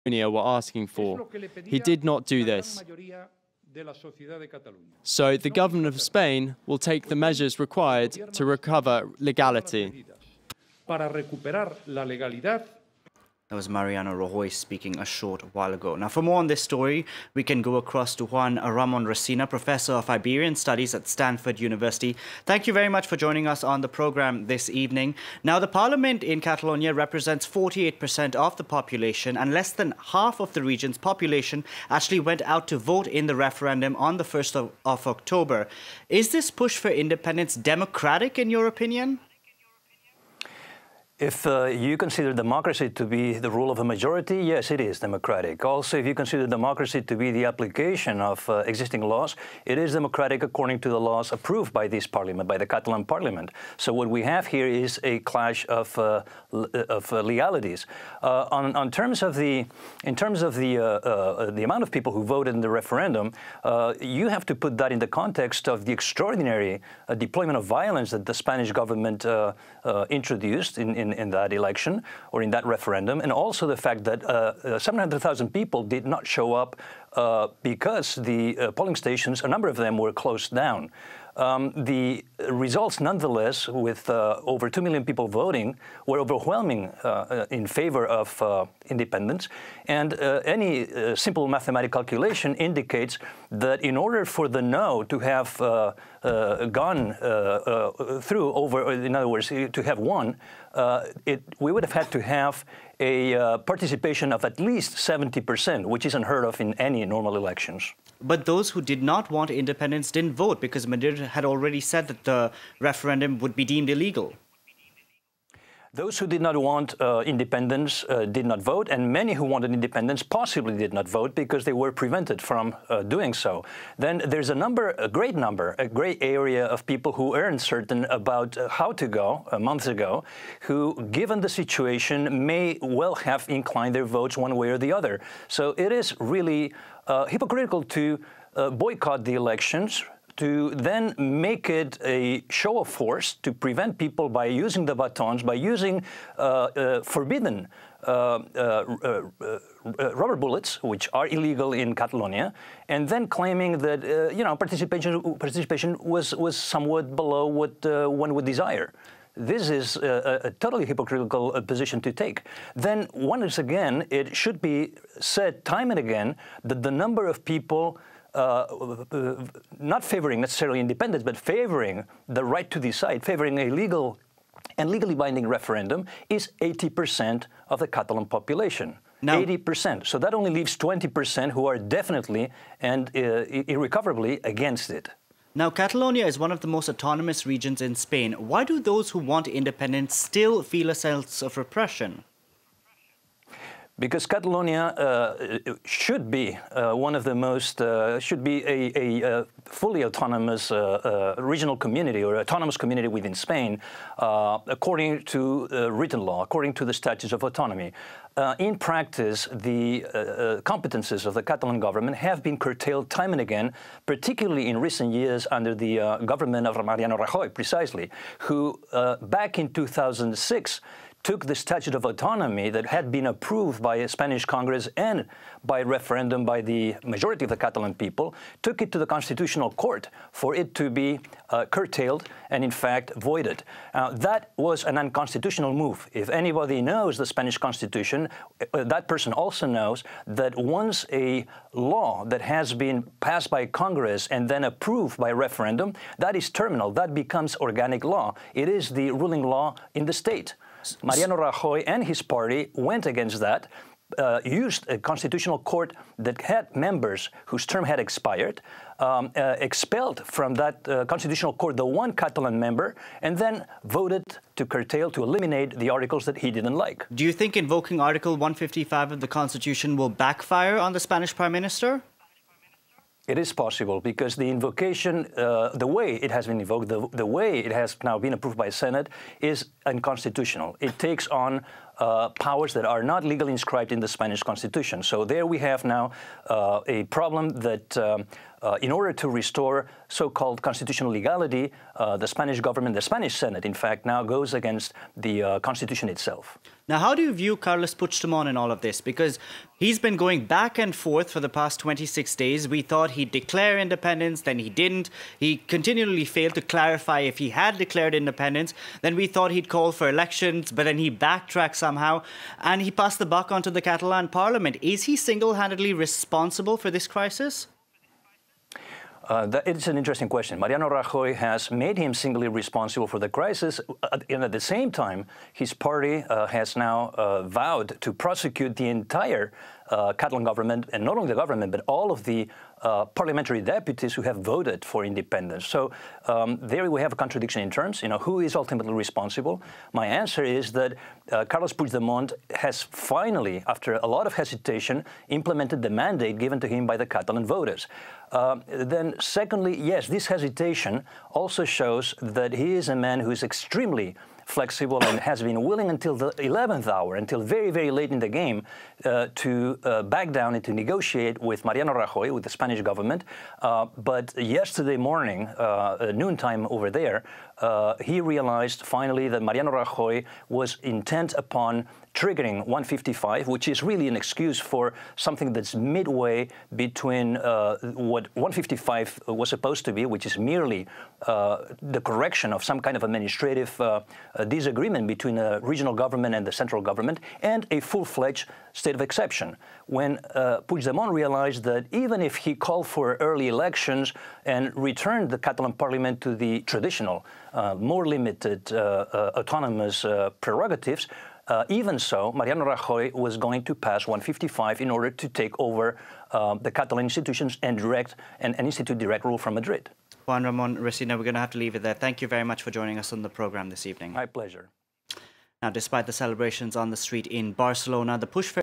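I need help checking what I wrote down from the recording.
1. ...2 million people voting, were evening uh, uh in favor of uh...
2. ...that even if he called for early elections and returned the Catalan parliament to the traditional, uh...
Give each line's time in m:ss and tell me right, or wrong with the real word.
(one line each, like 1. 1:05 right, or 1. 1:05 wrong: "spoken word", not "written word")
1. 1:24 wrong: "overwhelming", not "evening"
2. 6:31 right.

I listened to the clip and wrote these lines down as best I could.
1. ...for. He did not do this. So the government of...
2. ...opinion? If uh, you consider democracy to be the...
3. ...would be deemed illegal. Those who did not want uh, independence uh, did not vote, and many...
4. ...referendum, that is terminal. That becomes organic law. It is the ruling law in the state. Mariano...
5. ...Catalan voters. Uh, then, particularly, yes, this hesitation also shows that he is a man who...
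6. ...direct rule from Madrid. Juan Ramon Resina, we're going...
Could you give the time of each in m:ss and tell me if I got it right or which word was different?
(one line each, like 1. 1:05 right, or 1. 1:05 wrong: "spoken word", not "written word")
1. 0:00 right
2. 0:38 right
3. 1:53 right
4. 4:05 right
5. 5:47 wrong: "secondly", not "particularly"
6. 6:48 right.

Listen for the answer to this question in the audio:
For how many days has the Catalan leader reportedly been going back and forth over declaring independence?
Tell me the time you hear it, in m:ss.
5:01.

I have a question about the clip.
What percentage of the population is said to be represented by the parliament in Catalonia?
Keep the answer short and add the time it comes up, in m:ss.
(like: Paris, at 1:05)
48%, at 0:27.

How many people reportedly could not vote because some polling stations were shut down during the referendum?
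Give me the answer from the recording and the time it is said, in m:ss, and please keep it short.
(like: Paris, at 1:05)
700,000, at 1:14.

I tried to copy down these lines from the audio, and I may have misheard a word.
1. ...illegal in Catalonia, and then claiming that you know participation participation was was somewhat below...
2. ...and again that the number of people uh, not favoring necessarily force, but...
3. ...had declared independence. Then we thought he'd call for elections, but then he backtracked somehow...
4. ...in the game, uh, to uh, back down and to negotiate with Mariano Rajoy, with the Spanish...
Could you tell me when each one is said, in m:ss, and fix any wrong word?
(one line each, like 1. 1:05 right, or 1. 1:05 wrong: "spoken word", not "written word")
1. 2:31 right
2. 2:45 wrong: "independence", not "force"
3. 5:07 right
4. 5:58 right.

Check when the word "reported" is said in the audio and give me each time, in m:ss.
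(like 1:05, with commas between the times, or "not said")
not said.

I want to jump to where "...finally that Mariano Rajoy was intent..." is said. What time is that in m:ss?
6:08.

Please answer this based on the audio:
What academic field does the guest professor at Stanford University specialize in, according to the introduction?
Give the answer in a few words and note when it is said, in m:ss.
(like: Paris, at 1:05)
Iberian Studies, at 0:20.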